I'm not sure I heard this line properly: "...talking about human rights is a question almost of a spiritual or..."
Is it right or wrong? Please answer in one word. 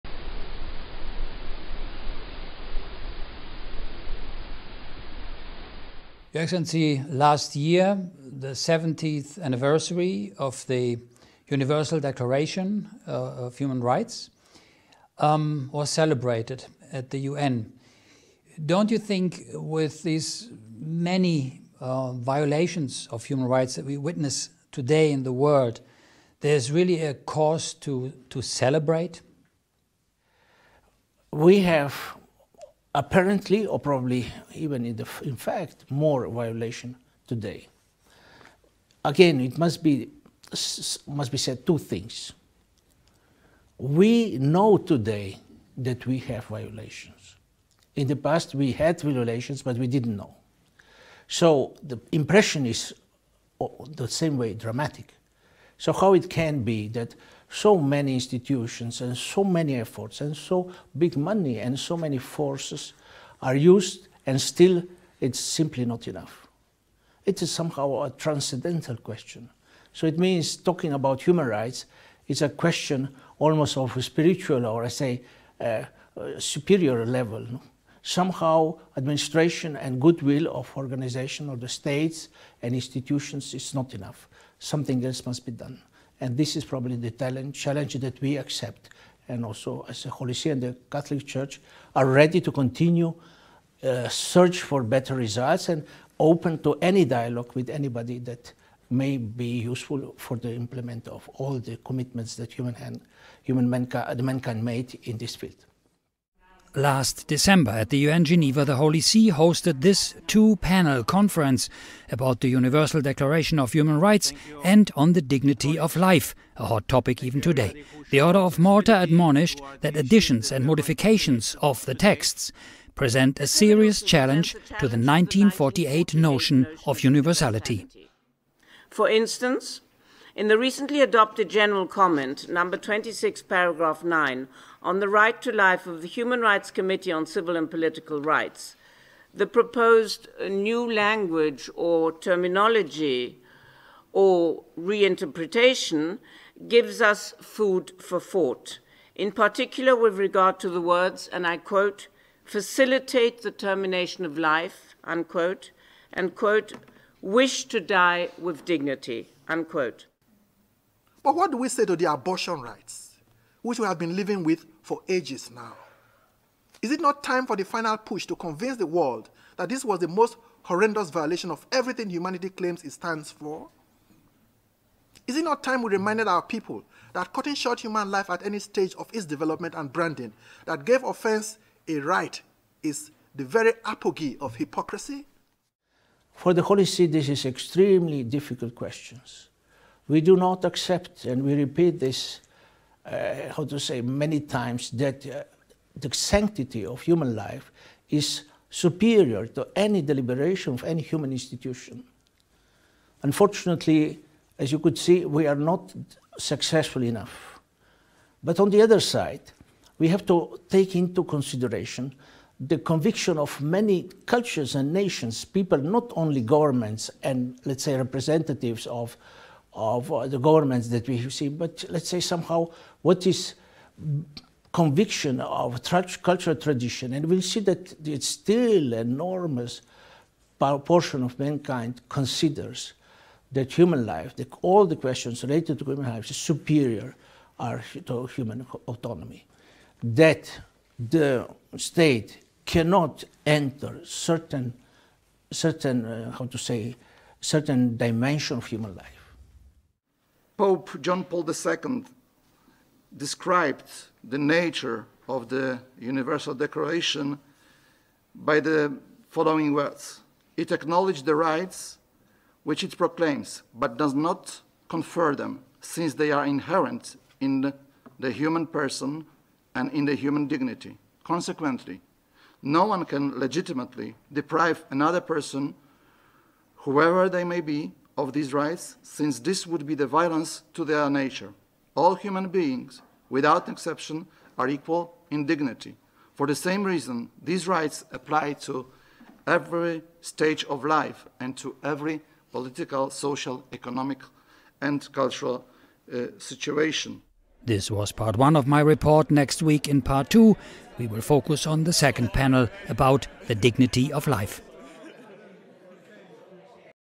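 right.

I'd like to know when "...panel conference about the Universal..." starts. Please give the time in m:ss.
1:50.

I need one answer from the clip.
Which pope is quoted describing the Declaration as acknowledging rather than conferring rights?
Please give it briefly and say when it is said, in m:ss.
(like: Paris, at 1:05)
Pope John Paul II, at 4:10.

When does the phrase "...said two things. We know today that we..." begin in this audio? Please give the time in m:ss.
0:41.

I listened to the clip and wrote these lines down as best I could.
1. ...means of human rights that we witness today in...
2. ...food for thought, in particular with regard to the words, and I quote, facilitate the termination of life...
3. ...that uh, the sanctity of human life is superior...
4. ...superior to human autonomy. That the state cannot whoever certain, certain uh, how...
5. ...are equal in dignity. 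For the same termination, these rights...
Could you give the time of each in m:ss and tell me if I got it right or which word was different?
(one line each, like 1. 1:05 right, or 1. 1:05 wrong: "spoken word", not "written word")
1. 0:22 wrong: "violations", not "means"
2. 2:27 right
3. 3:14 right
4. 3:56 wrong: "enter", not "whoever"
5. 4:44 wrong: "reason", not "termination".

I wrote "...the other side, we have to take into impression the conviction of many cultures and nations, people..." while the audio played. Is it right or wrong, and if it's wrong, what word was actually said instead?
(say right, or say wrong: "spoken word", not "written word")
wrong: "consideration", not "impression".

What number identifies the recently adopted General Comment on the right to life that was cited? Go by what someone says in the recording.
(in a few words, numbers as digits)
26.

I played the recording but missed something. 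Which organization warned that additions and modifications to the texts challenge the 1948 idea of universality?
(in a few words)
Order of Malta.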